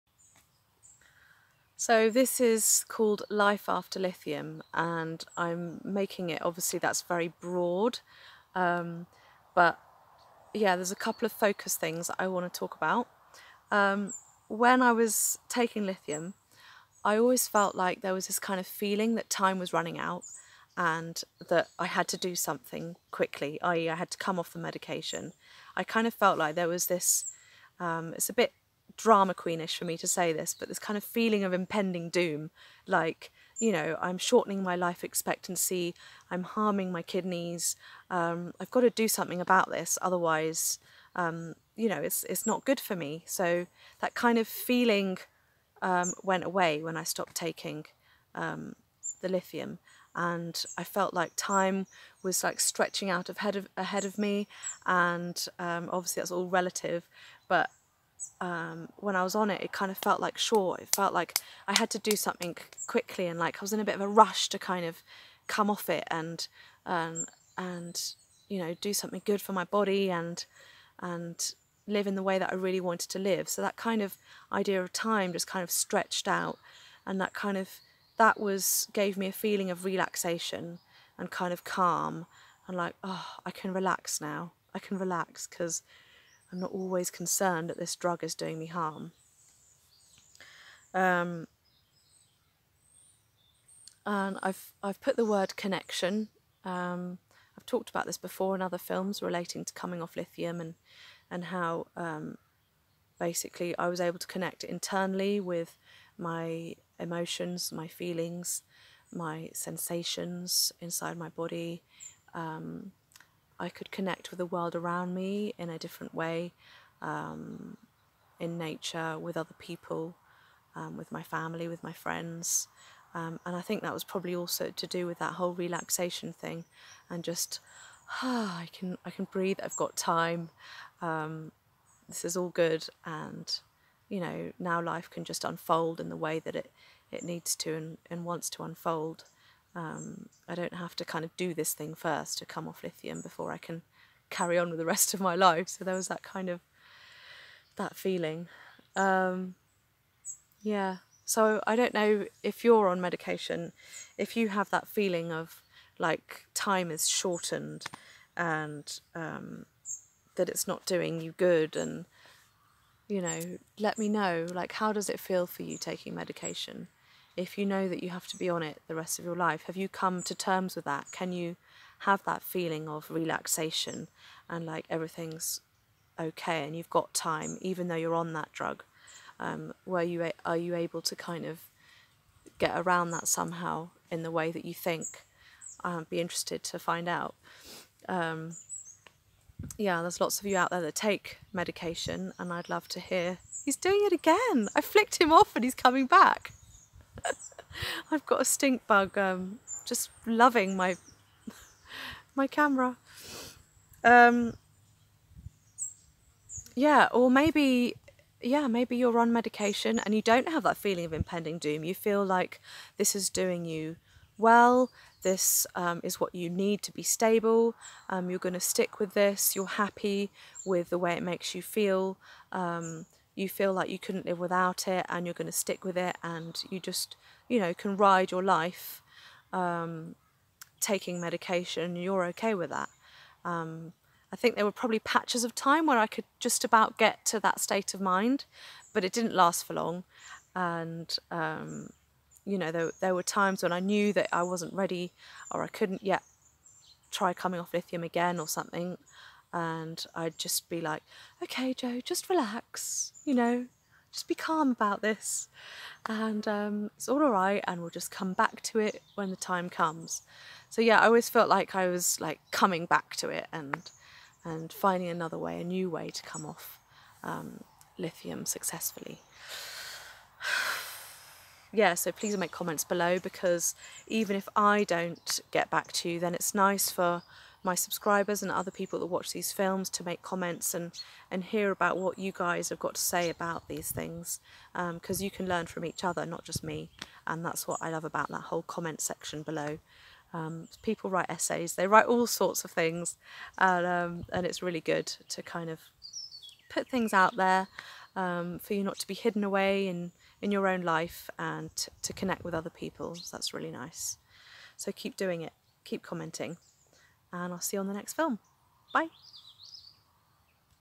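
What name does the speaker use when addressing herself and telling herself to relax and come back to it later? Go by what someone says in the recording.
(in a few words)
Joe.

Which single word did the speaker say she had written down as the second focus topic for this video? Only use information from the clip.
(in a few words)
Connection.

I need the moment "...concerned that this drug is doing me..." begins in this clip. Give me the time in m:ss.
1:27.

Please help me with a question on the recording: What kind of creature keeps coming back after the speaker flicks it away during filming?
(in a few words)
Stink bug.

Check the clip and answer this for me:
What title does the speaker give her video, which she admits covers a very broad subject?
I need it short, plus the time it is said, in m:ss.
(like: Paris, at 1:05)
Life After Lithium, at 0:03.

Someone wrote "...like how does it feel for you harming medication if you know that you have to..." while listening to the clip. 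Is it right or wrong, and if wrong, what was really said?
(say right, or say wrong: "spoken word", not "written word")
wrong: "taking", not "harming".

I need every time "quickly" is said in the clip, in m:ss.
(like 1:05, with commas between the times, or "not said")
0:23, 1:02.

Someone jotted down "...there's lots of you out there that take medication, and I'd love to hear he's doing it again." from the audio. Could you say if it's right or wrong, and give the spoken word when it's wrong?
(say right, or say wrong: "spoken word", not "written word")
right.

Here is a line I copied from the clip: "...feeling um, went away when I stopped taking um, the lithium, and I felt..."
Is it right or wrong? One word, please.
right.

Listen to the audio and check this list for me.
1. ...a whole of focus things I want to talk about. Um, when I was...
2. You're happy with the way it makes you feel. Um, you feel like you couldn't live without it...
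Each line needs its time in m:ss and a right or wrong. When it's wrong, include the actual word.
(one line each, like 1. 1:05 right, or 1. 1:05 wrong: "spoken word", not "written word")
1. 0:10 wrong: "couple", not "whole"
2. 3:39 right.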